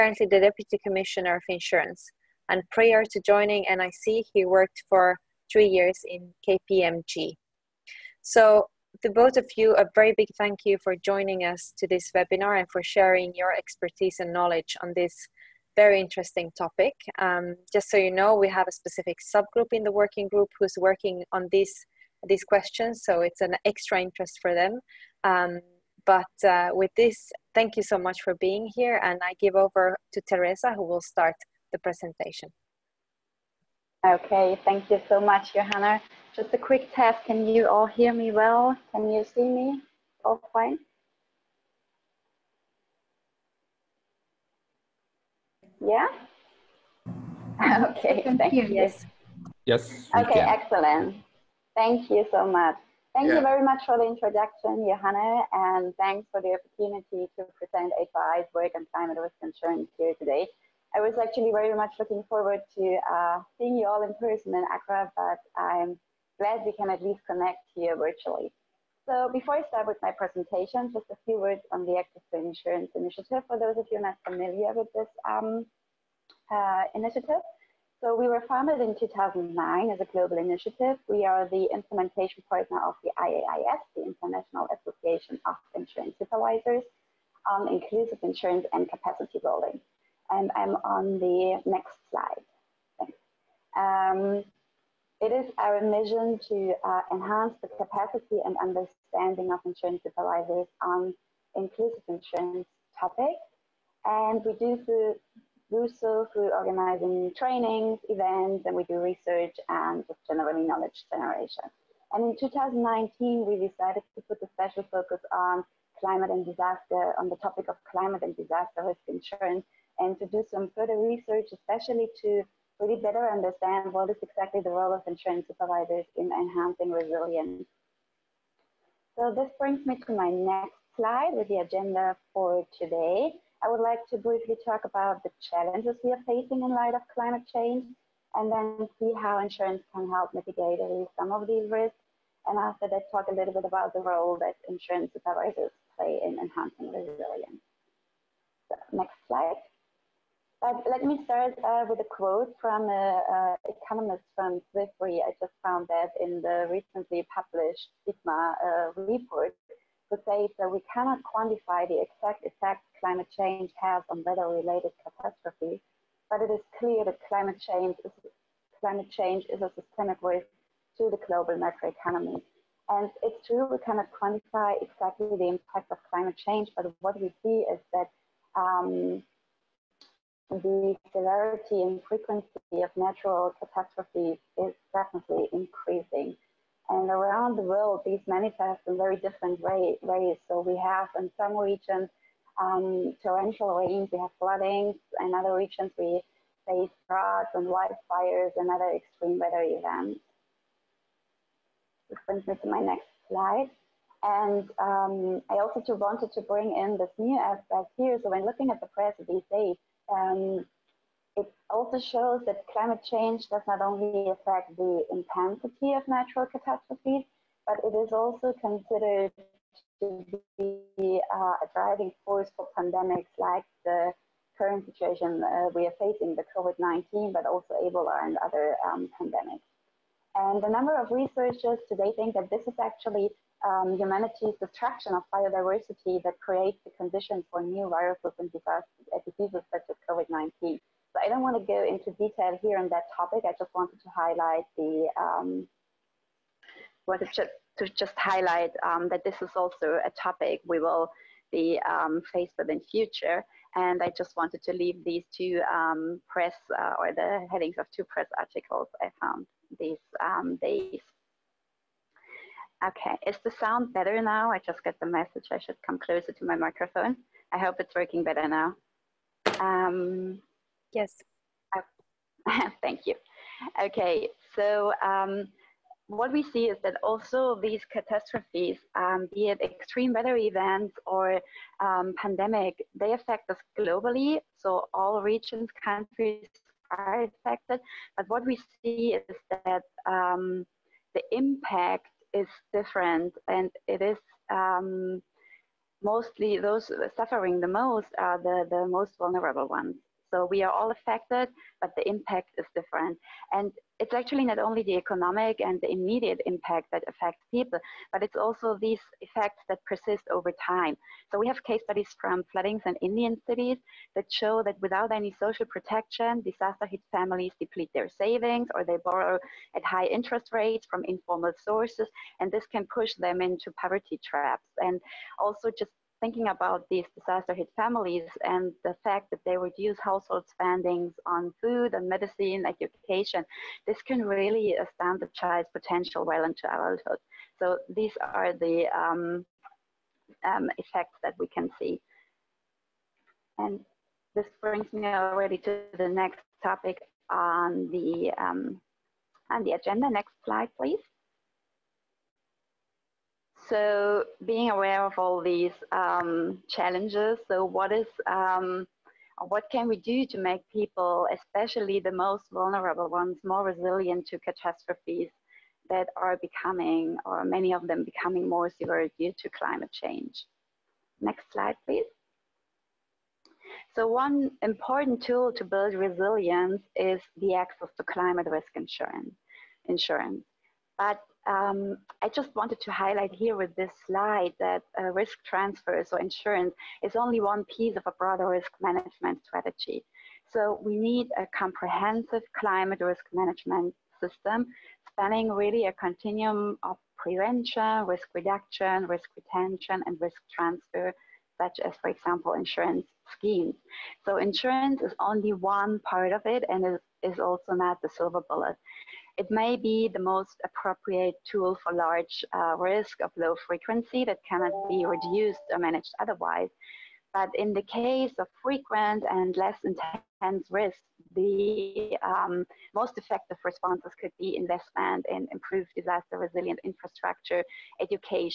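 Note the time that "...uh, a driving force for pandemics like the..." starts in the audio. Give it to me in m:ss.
3:41.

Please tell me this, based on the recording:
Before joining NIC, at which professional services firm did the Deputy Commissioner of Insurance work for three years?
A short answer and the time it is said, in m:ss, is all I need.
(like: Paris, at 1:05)
KPMG, at 0:06.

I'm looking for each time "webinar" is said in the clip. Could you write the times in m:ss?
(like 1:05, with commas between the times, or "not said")
0:12.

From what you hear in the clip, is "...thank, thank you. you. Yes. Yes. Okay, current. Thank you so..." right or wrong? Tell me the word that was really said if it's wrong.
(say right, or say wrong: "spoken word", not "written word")
wrong: "excellent", not "current".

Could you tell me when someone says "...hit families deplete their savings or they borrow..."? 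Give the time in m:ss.
5:16.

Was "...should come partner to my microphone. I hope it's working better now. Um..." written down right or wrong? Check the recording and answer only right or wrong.
wrong.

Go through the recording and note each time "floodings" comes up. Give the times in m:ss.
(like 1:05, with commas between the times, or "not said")
3:14, 5:12.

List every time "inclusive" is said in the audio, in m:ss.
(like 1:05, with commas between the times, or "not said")
1:27, 1:41.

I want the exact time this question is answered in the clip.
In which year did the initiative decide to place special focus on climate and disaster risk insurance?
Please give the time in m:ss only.
1:52.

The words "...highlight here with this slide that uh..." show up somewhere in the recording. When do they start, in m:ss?
6:22.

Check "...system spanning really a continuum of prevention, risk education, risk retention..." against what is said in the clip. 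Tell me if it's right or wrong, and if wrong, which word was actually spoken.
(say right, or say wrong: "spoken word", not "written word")
wrong: "reduction", not "education".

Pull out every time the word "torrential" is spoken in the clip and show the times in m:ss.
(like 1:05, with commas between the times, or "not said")
3:13.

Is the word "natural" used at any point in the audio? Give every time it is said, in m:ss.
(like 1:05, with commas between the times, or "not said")
3:02, 3:36.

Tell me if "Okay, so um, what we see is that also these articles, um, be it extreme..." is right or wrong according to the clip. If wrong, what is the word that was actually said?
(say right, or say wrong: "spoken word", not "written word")
wrong: "catastrophes", not "articles".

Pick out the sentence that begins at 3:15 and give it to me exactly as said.
In other regions, we face droughts and wildfires and other extreme weather events.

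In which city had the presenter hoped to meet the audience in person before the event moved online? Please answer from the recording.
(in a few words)
Accra.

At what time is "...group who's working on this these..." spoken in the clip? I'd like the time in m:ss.
0:20.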